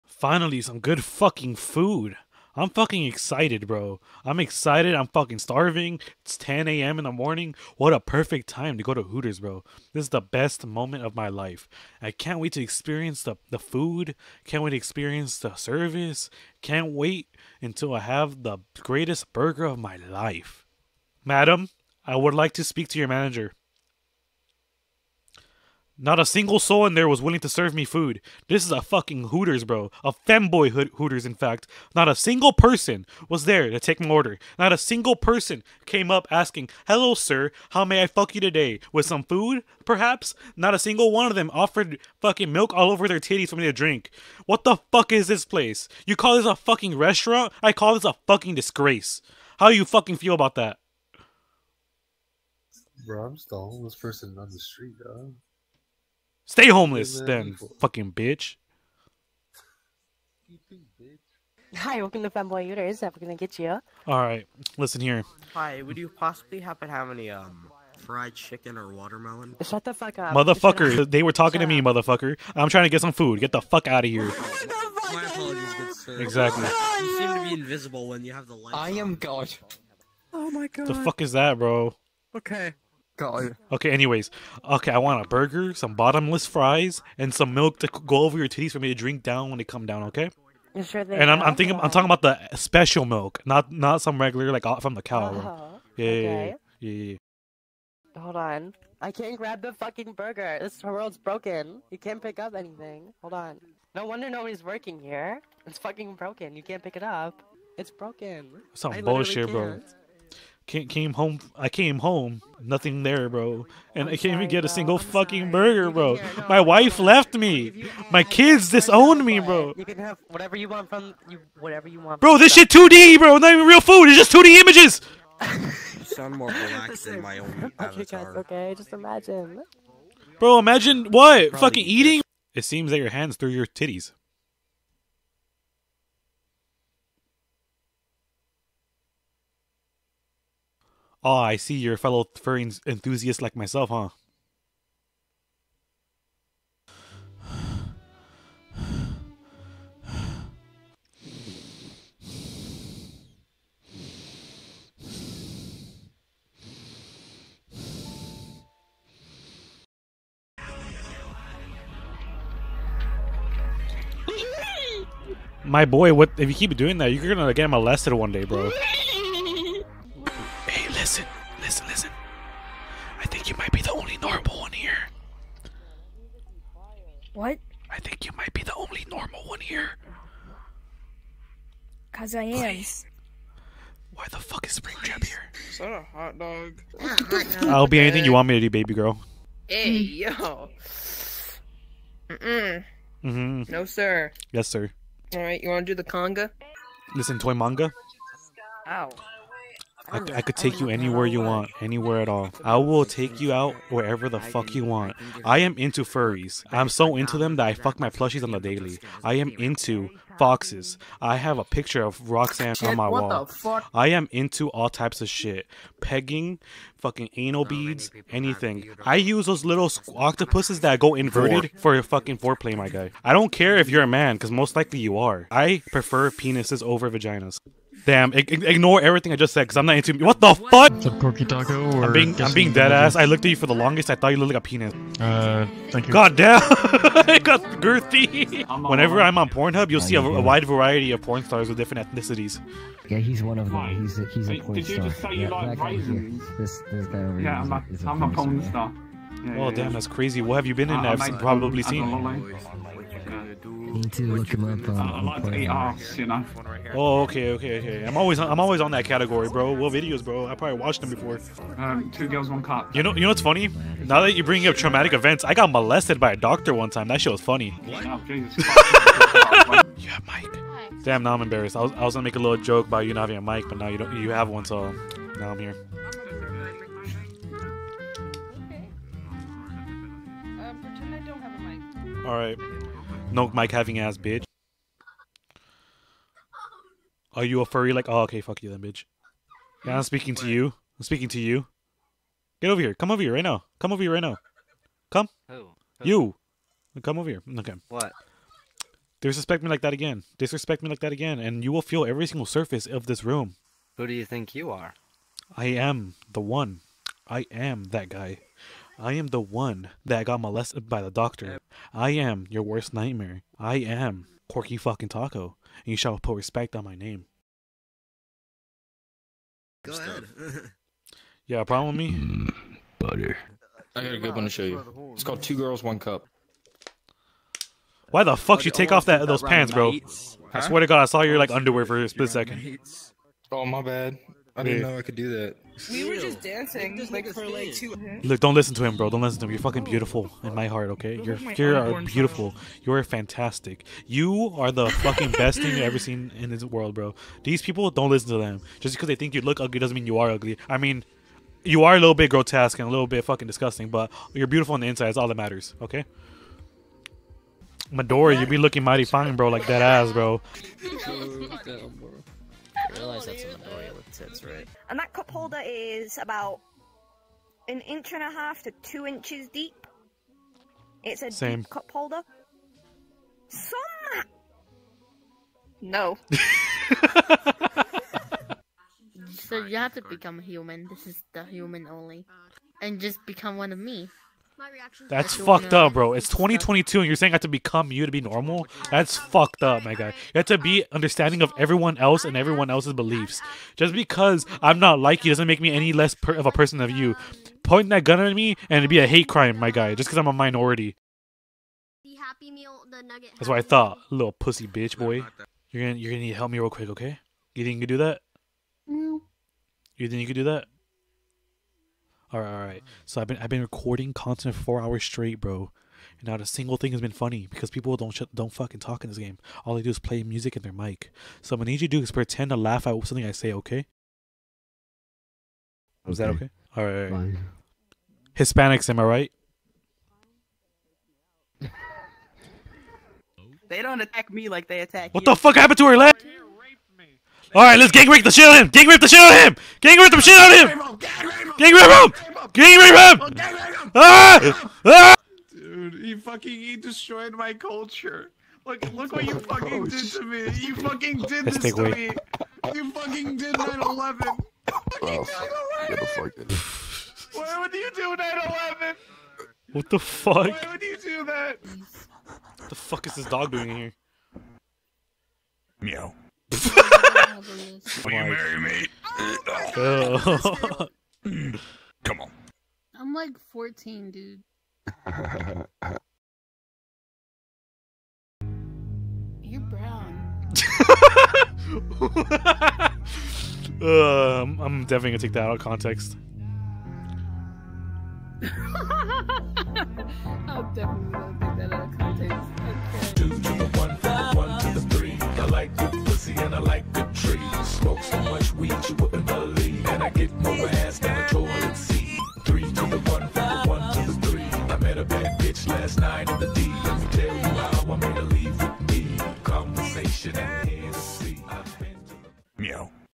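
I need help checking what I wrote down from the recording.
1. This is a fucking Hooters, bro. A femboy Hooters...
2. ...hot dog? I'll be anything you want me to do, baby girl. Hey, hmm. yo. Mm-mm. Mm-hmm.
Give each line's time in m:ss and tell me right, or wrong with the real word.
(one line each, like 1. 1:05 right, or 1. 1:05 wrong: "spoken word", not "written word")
1. 0:28 right
2. 3:06 right.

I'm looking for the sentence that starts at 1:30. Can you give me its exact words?
sure they and I'm, I'm thinking, that.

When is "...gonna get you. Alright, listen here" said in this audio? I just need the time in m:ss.
1:03.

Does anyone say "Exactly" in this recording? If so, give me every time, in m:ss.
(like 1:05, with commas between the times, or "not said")
1:16.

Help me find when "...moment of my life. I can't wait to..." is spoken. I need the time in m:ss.
0:10.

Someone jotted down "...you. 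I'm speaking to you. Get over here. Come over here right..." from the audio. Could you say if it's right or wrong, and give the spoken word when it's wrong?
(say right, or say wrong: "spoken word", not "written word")
right.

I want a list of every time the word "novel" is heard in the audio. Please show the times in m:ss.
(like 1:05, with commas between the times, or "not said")
not said.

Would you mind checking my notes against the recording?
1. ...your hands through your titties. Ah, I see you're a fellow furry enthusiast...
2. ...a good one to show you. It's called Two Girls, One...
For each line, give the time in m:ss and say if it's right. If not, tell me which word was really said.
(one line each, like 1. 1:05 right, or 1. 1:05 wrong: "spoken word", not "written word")
1. 2:12 right
2. 5:24 right.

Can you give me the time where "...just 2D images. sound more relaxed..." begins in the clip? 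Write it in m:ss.
2:04.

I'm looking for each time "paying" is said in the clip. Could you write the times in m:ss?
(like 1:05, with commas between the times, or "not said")
not said.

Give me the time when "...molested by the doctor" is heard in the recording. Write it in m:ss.
5:10.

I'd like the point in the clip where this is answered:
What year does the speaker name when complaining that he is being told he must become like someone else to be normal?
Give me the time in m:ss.
6:26.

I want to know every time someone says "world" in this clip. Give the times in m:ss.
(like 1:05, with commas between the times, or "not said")
1:40, 5:46.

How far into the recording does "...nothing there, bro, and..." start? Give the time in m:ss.
1:52.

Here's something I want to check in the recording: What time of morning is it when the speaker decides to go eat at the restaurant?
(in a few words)
10 a.m.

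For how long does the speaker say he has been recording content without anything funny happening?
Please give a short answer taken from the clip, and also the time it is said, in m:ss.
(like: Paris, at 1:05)
4 hours, at 6:54.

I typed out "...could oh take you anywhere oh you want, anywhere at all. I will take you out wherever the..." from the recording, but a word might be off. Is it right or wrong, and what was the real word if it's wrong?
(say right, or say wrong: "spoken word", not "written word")
right.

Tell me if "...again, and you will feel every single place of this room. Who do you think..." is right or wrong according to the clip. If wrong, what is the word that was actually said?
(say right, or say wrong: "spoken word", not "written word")
wrong: "surface", not "place".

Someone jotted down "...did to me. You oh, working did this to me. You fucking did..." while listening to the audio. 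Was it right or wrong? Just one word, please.
wrong.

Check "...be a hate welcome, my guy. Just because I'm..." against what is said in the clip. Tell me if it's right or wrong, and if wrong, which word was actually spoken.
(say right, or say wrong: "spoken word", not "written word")
wrong: "crime", not "welcome".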